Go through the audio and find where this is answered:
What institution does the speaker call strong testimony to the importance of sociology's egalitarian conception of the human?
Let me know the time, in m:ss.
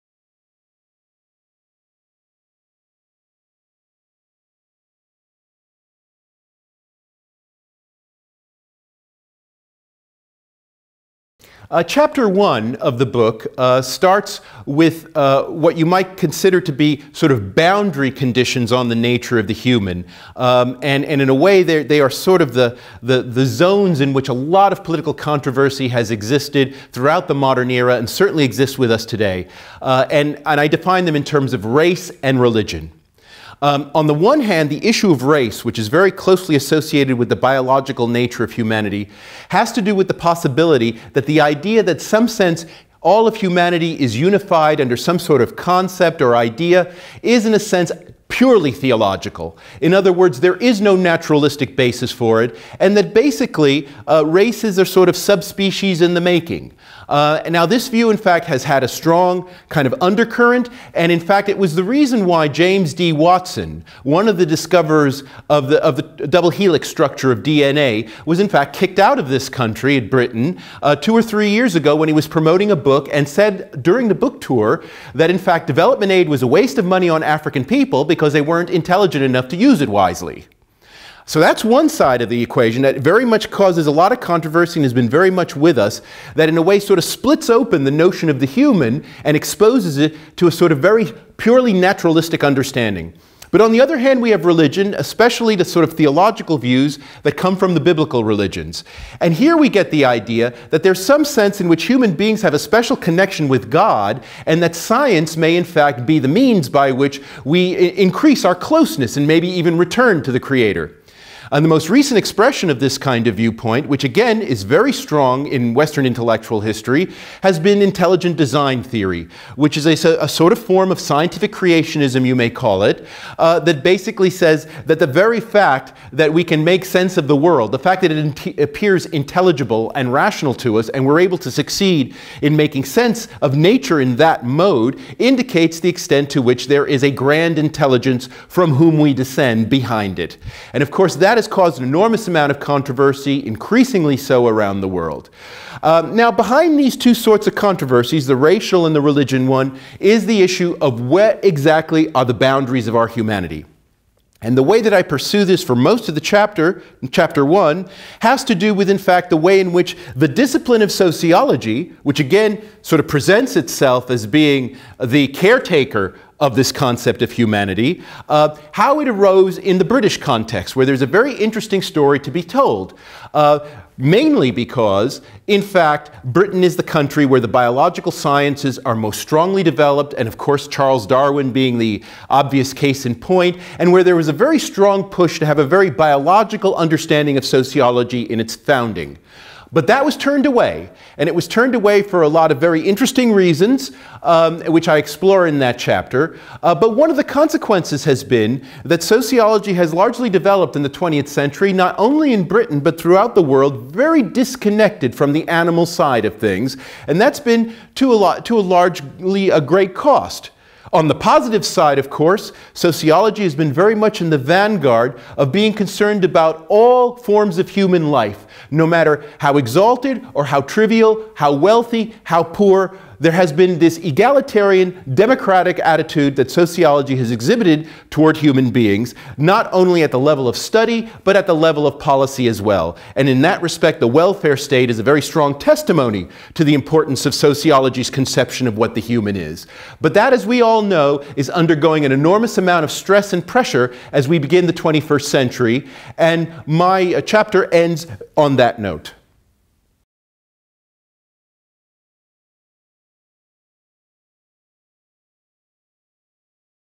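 3:53.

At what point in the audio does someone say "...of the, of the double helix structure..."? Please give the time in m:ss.
1:05.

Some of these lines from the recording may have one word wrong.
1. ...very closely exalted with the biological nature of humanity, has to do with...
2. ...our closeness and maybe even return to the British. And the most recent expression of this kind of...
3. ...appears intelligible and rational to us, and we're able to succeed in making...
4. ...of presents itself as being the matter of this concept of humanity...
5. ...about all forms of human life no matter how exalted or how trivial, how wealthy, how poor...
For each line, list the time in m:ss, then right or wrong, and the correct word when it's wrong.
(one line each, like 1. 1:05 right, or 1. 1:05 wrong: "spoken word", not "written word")
1. 0:35 wrong: "associated", not "exalted"
2. 1:48 wrong: "Creator", not "British"
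3. 2:08 right
4. 2:42 wrong: "caretaker", not "matter"
5. 3:36 right.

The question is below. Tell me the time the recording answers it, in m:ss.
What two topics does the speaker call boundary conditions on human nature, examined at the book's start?
0:31.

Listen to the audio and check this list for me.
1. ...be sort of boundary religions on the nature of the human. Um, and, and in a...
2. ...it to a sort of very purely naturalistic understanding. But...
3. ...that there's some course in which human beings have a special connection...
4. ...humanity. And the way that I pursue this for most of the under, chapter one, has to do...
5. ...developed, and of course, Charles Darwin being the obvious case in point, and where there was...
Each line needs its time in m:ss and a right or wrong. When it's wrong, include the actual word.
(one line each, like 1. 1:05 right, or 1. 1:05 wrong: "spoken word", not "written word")
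1. 0:16 wrong: "conditions", not "religions"
2. 1:29 right
3. 1:40 wrong: "sense", not "course"
4. 2:33 wrong: "chapter", not "under"
5. 2:59 right.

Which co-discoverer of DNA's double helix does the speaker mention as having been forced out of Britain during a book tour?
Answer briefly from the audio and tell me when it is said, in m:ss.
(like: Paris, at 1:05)
James D. Watson, at 1:02.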